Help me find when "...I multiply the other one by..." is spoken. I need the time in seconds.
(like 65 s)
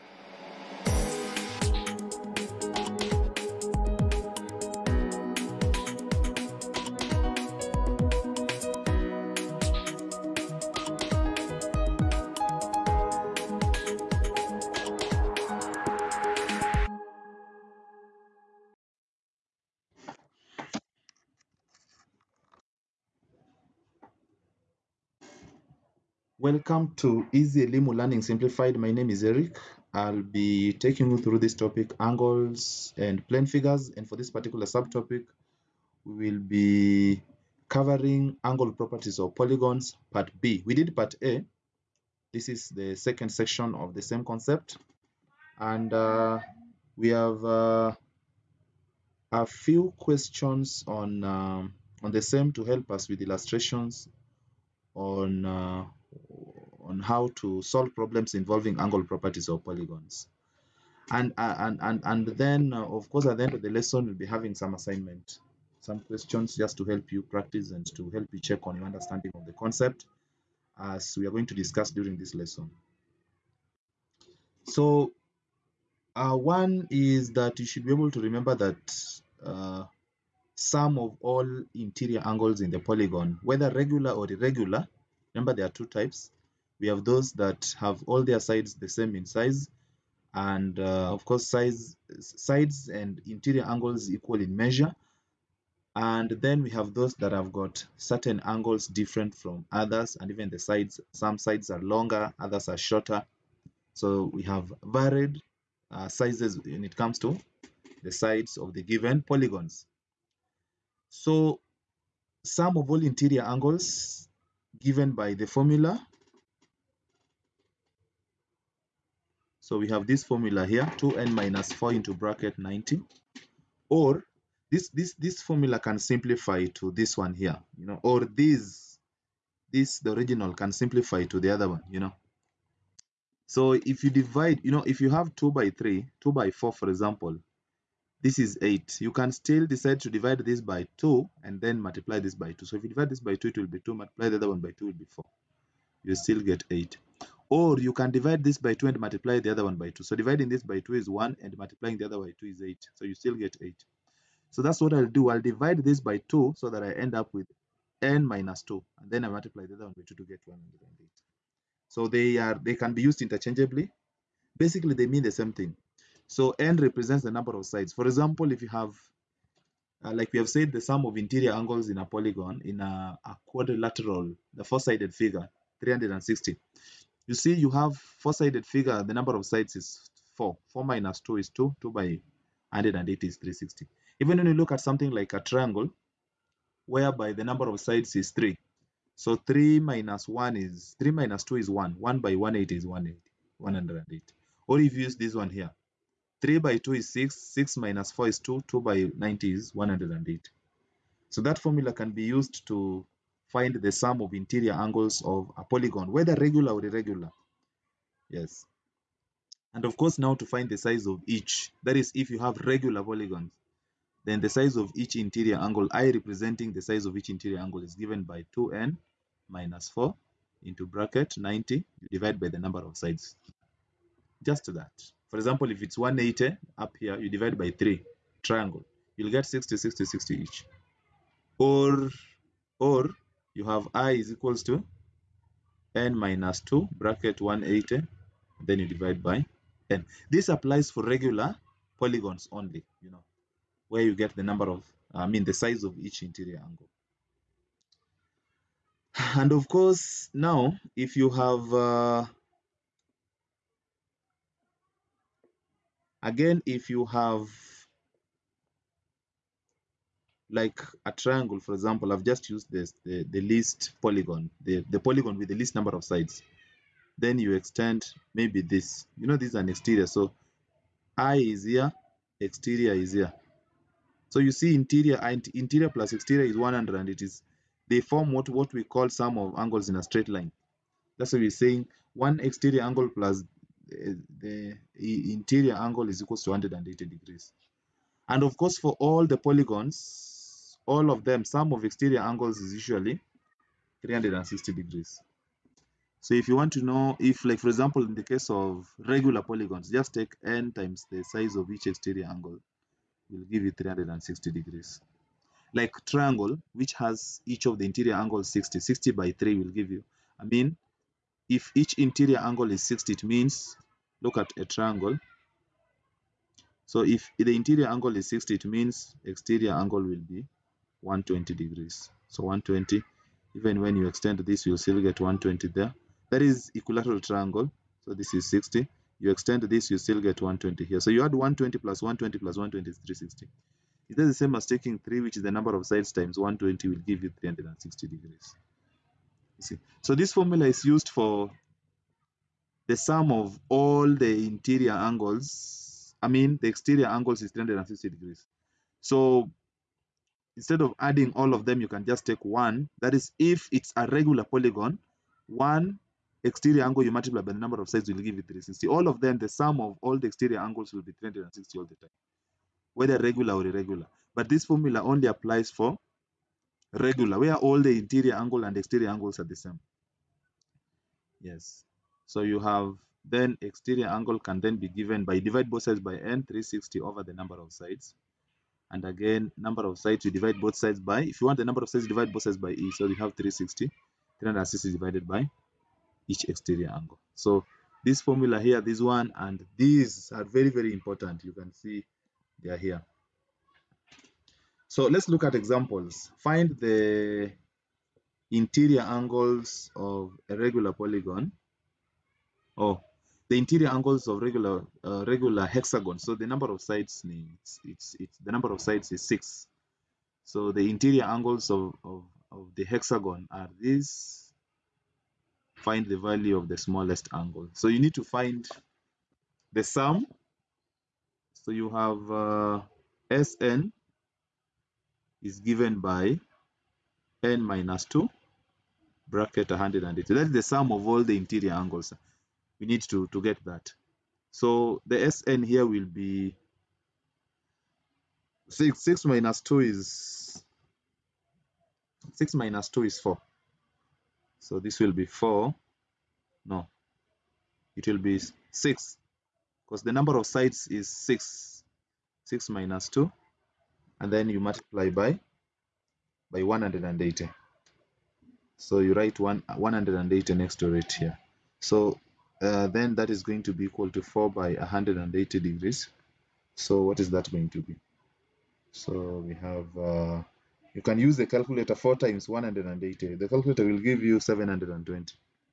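159 s.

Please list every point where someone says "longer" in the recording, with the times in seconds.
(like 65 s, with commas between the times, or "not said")
101 s.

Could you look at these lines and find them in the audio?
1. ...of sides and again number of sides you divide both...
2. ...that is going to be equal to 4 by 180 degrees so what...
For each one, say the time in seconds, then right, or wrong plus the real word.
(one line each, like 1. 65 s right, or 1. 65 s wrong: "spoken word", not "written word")
1. 377 s right
2. 463 s right.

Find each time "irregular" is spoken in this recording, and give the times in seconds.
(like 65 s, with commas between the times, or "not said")
84 s, 206 s, 363 s.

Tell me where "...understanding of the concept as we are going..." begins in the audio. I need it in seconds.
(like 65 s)
68 s.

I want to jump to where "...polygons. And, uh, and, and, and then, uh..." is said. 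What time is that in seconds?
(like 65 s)
59 s.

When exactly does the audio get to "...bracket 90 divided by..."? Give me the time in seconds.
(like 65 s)
220 s.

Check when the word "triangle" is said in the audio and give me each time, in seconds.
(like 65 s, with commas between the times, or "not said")
185 s, 228 s, 261 s, 306 s, 314 s, 327 s.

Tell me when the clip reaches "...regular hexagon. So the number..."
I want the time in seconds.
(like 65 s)
405 s.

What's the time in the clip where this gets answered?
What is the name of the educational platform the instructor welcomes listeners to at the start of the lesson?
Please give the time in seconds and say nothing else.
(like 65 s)
27 s.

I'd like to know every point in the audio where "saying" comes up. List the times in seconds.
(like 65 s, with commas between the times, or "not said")
281 s.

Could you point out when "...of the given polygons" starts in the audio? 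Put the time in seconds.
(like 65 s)
108 s.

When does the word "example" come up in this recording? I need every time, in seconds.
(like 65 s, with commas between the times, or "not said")
136 s, 168 s, 225 s, 261 s, 297 s, 395 s.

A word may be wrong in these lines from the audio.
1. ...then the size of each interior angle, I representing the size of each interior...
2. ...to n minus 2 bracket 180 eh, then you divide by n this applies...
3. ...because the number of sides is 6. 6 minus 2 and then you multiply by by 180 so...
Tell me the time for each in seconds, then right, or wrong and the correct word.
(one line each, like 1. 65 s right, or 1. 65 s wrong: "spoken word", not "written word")
1. 214 s right
2. 234 s right
3. 449 s right.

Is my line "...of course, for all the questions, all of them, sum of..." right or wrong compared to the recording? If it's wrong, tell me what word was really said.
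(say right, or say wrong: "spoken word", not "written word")
wrong: "polygons", not "questions".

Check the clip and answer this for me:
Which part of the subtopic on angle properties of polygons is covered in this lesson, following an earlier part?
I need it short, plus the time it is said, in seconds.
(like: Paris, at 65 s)
Part B, at 40 s.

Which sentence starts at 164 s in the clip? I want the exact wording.
Basically, they mean the same thing.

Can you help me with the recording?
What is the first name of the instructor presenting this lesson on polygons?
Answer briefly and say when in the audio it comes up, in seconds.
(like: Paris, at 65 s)
Eric, at 29 s.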